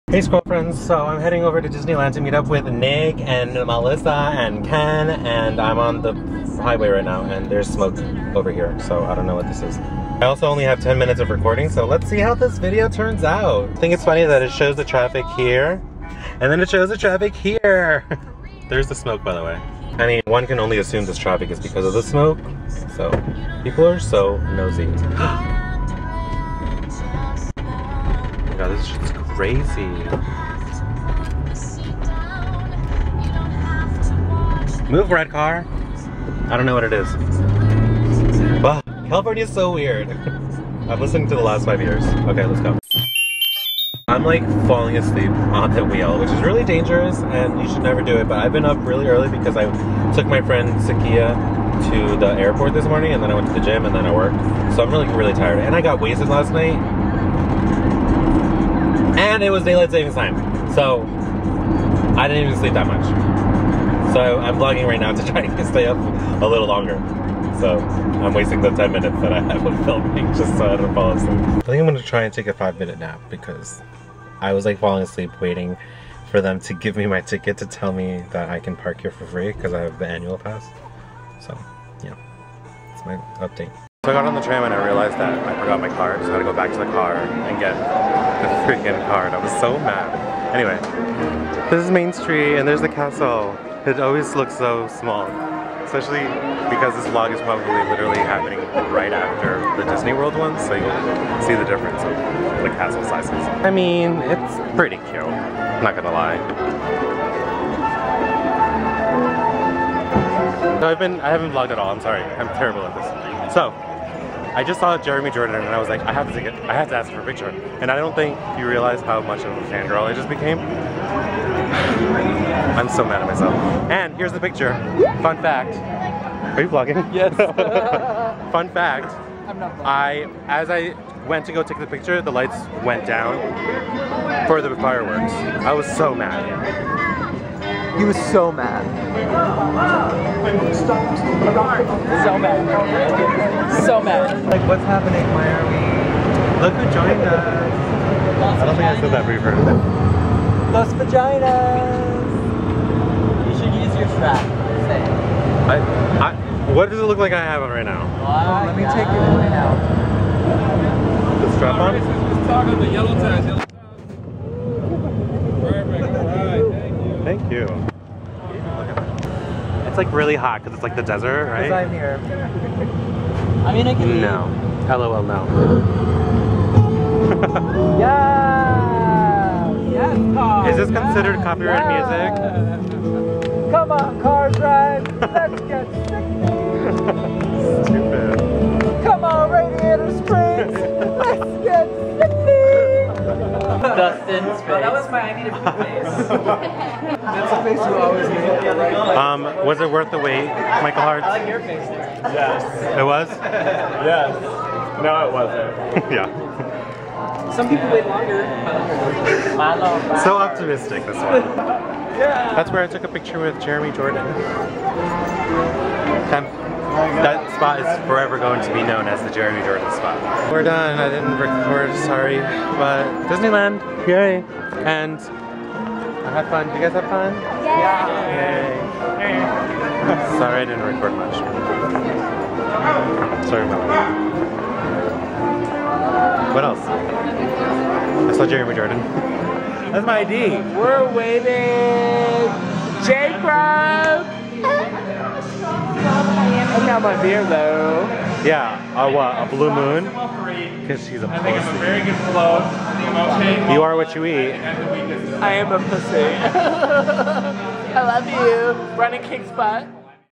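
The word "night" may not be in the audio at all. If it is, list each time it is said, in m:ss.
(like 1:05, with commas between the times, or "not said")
0:56.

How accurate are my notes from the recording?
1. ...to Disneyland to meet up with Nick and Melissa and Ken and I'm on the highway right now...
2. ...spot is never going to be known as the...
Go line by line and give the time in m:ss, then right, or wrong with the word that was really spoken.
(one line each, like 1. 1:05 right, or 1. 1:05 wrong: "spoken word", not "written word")
1. 0:01 right
2. 3:37 wrong: "forever", not "never".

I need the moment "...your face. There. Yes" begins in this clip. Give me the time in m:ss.
3:21.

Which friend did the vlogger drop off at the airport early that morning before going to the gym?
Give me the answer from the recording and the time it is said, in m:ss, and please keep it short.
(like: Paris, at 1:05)
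Sakia, at 0:50.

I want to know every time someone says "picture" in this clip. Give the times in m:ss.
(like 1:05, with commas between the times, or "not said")
1:57, 2:04, 2:11, 3:33.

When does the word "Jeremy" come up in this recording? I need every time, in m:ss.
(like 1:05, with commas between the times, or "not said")
1:54, 3:33, 3:39, 3:58.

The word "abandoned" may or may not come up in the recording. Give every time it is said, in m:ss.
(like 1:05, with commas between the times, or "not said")
not said.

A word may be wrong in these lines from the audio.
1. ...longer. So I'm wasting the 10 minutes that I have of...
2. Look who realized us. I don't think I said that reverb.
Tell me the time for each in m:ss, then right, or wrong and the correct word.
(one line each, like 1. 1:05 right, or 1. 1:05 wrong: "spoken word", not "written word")
1. 1:06 right
2. 2:26 wrong: "joined", not "realized".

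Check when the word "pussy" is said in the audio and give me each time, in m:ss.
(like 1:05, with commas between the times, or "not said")
4:11, 4:15.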